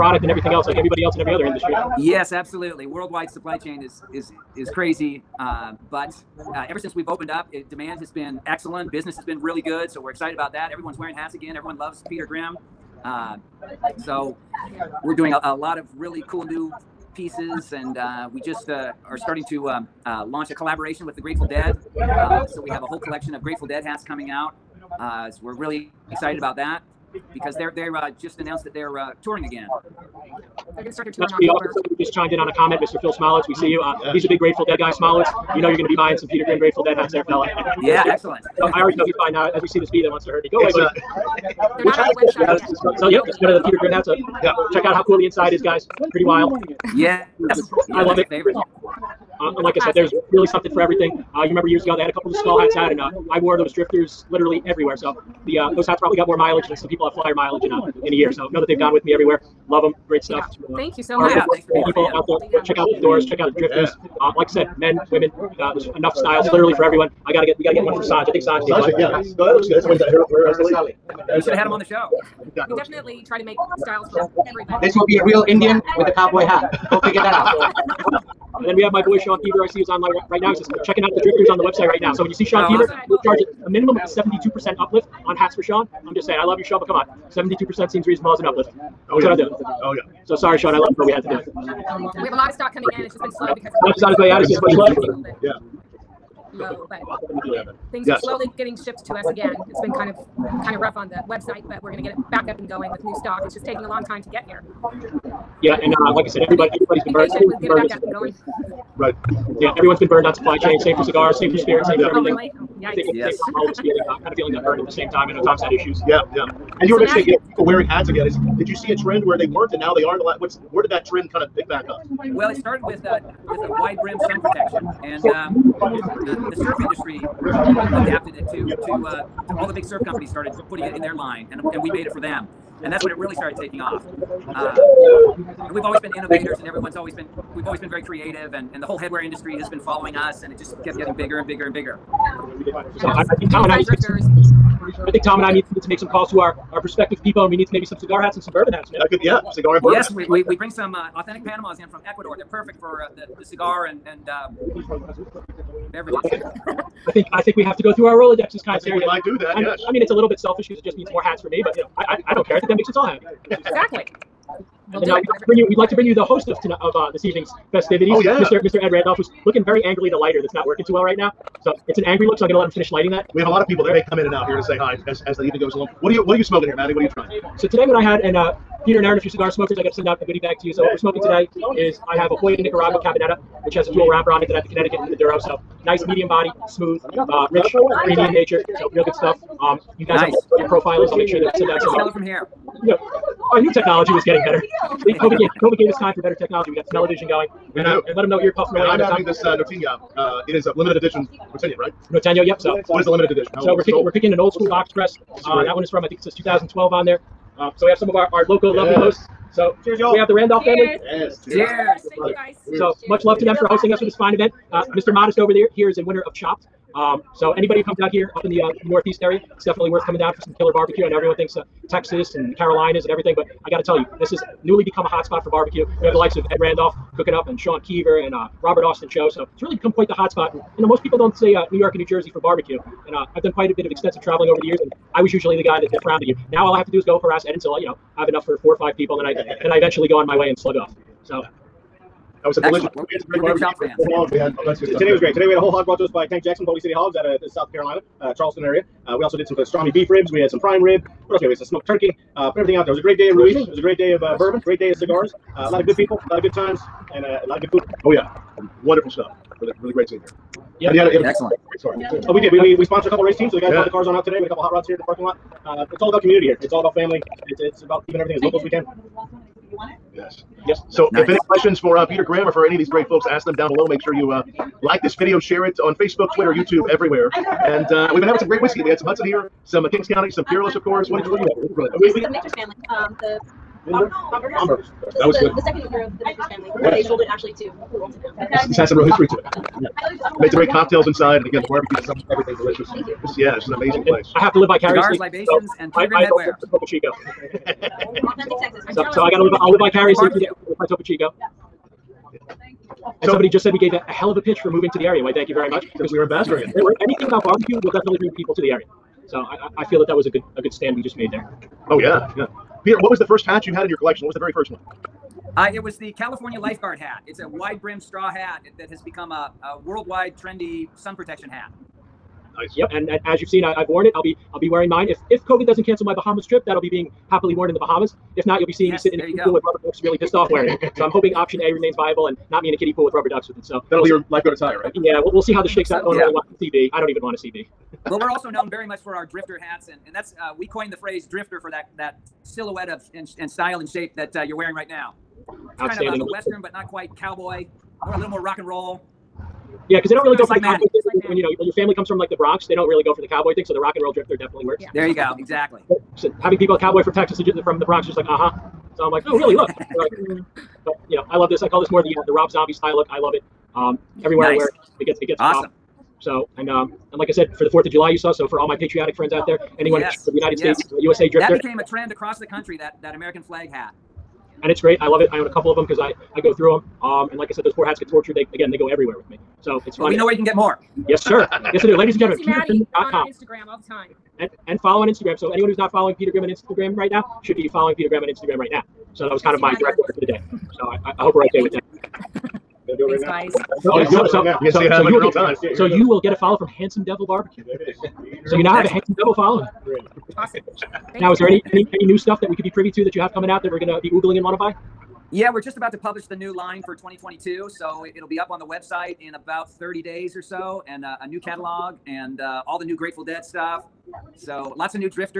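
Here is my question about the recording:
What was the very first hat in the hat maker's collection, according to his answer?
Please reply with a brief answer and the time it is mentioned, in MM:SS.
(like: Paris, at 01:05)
California lifeguard hat, at 05:16.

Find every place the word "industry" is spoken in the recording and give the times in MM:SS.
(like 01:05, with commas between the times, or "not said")
00:01, 02:06, 02:19.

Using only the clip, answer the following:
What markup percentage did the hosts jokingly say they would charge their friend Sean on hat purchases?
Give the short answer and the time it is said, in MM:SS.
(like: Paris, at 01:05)
72%, at 01:24.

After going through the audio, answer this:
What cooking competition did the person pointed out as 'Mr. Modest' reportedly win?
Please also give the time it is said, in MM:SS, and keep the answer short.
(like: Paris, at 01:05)
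Chopped, at 03:36.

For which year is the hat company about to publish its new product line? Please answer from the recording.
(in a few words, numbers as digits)
2022.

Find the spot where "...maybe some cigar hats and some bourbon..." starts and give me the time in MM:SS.
02:27.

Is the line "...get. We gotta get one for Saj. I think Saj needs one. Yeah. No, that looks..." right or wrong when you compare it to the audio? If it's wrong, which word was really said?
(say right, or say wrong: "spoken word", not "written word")
right.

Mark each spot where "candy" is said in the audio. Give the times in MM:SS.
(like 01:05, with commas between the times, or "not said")
not said.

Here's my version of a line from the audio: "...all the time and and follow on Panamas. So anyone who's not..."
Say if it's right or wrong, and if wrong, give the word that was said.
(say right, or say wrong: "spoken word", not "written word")
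wrong: "Instagram", not "Panamas".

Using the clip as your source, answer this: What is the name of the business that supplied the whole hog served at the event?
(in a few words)
Boulder City Hogs.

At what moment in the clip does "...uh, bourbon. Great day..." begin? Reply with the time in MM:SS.
04:14.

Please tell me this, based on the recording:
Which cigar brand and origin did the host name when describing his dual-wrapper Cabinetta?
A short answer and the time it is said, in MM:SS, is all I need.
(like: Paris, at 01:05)
Hoya Nicaragua, at 03:02.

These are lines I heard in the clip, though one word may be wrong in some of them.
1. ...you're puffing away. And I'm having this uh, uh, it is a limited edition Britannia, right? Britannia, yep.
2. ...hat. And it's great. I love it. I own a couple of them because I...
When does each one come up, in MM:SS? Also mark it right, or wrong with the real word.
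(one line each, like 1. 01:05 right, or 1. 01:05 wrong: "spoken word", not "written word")
1. 03:18 right
2. 06:13 right.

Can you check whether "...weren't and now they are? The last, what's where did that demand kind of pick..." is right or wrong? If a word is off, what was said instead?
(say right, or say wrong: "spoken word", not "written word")
wrong: "trend", not "demand".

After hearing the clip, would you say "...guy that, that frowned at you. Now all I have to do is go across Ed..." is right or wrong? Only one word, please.
wrong.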